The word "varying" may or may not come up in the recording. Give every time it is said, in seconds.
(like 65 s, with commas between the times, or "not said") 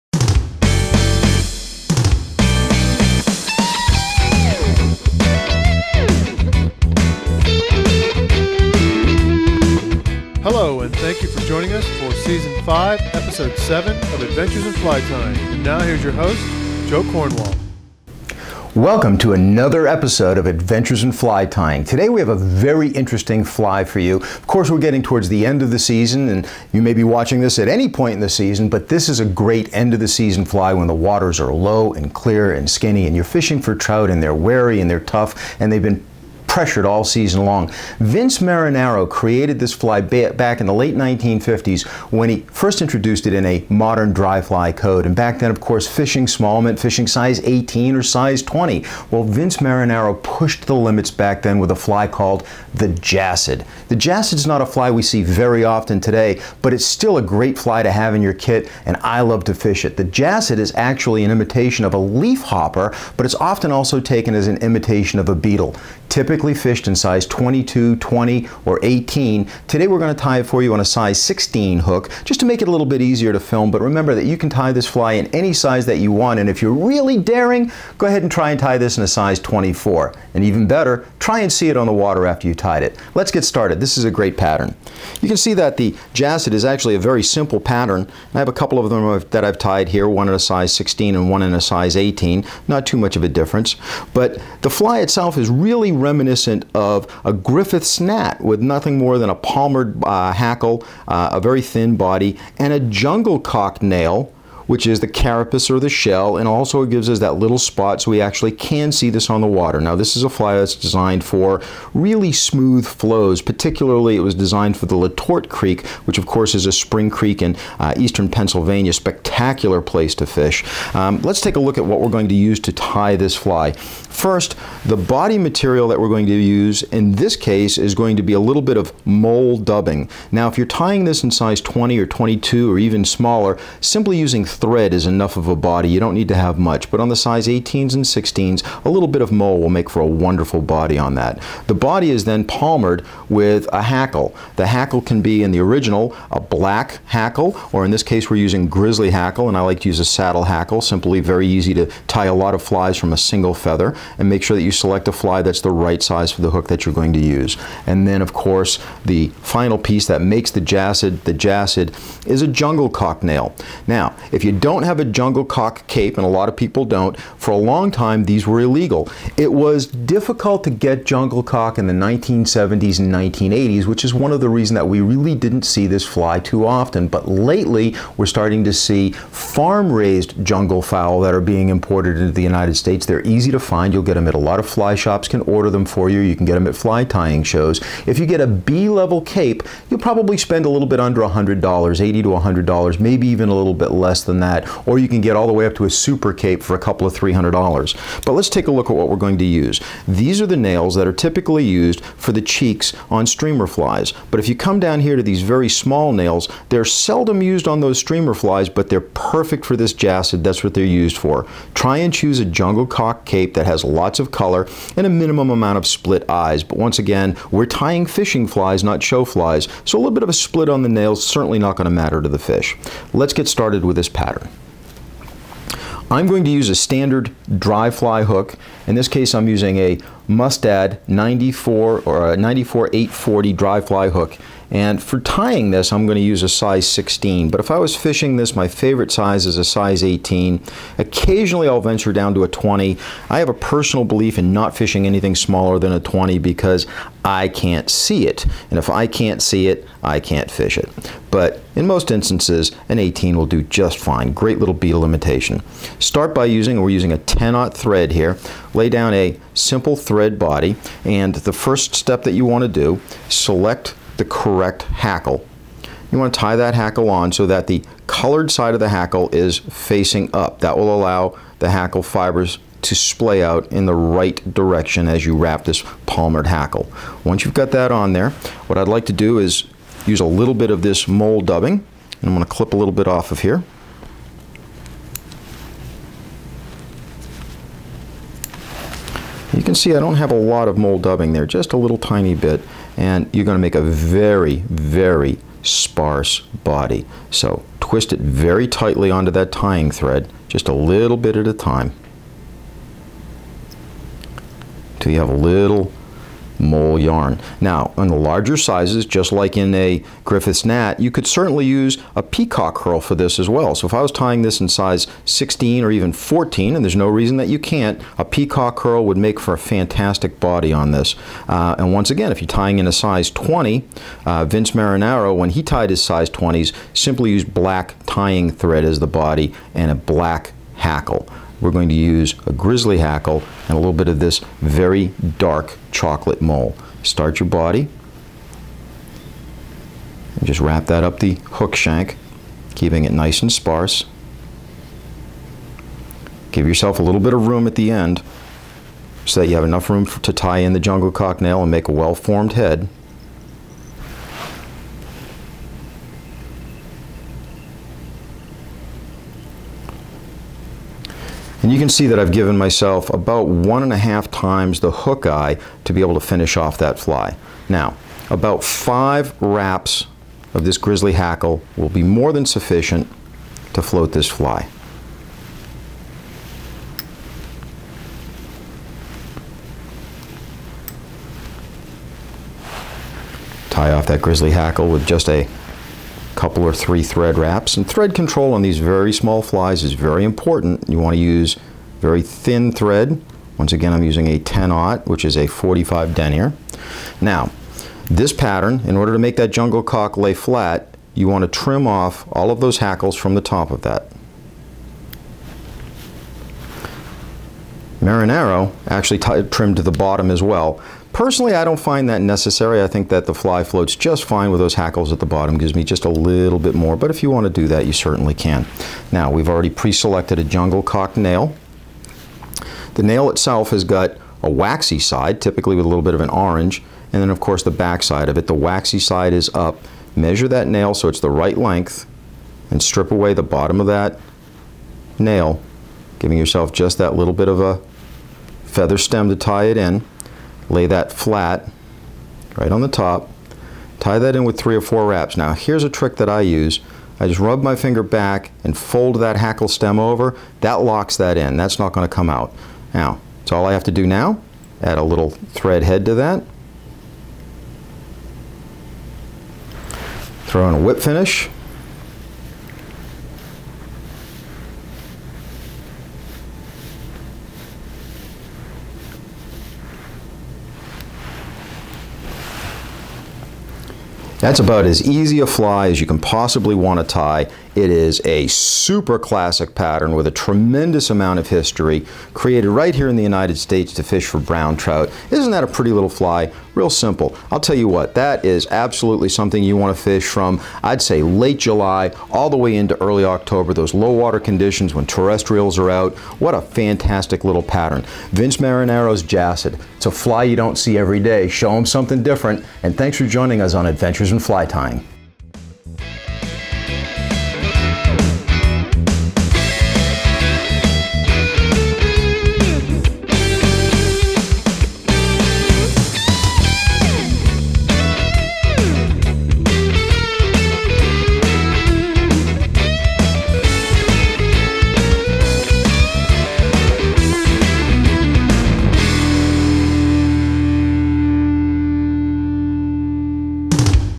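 not said.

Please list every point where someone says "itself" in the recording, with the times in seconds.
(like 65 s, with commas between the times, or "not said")
95 s, 423 s.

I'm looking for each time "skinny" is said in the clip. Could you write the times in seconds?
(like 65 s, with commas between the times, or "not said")
32 s.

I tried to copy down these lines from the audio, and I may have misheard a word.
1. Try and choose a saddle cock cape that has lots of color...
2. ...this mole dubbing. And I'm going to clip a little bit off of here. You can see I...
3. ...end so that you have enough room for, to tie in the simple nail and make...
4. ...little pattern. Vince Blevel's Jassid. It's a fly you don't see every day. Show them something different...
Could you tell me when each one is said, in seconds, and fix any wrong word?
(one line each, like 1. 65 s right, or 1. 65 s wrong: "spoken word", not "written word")
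1. 211 s wrong: "jungle", not "saddle"
2. 280 s right
3. 347 s wrong: "jungle", not "simple"
4. 497 s wrong: "Marinaro", not "Blevel".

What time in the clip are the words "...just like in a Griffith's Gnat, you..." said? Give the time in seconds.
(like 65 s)
309 s.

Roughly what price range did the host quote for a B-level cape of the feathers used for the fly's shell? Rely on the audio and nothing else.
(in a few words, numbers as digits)
$80 to $100.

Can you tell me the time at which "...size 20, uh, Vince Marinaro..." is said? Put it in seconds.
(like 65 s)
322 s.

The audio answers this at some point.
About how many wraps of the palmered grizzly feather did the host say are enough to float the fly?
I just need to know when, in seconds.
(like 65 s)
368 s.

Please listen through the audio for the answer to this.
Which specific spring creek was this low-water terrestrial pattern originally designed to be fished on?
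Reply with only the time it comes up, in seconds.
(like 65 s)
114 s.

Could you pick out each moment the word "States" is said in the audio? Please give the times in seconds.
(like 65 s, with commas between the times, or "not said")
182 s, 483 s.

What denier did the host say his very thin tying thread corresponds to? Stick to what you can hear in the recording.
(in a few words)
45 denier.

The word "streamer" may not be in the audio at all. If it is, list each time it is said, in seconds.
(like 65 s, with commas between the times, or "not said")
203 s, 207 s.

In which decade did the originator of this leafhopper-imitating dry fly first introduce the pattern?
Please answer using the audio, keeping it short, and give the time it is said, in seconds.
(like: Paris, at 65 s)
late 1950s, at 40 s.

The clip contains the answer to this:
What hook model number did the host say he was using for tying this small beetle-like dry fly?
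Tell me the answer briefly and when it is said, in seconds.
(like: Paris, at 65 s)
Mustad 94840, at 232 s.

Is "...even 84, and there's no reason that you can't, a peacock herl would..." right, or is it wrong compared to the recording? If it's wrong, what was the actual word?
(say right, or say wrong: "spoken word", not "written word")
wrong: "14", not "84".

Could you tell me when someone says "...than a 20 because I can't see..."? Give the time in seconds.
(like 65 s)
245 s.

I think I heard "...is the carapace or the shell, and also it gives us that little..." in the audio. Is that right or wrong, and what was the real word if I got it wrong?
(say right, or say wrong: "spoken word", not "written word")
right.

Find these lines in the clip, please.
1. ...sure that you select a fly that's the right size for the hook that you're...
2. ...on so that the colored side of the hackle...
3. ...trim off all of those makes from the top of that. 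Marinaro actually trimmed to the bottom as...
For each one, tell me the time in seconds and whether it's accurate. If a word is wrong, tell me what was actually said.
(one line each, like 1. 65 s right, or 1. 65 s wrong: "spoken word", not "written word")
1. 154 s right
2. 267 s right
3. 401 s wrong: "hackles", not "makes".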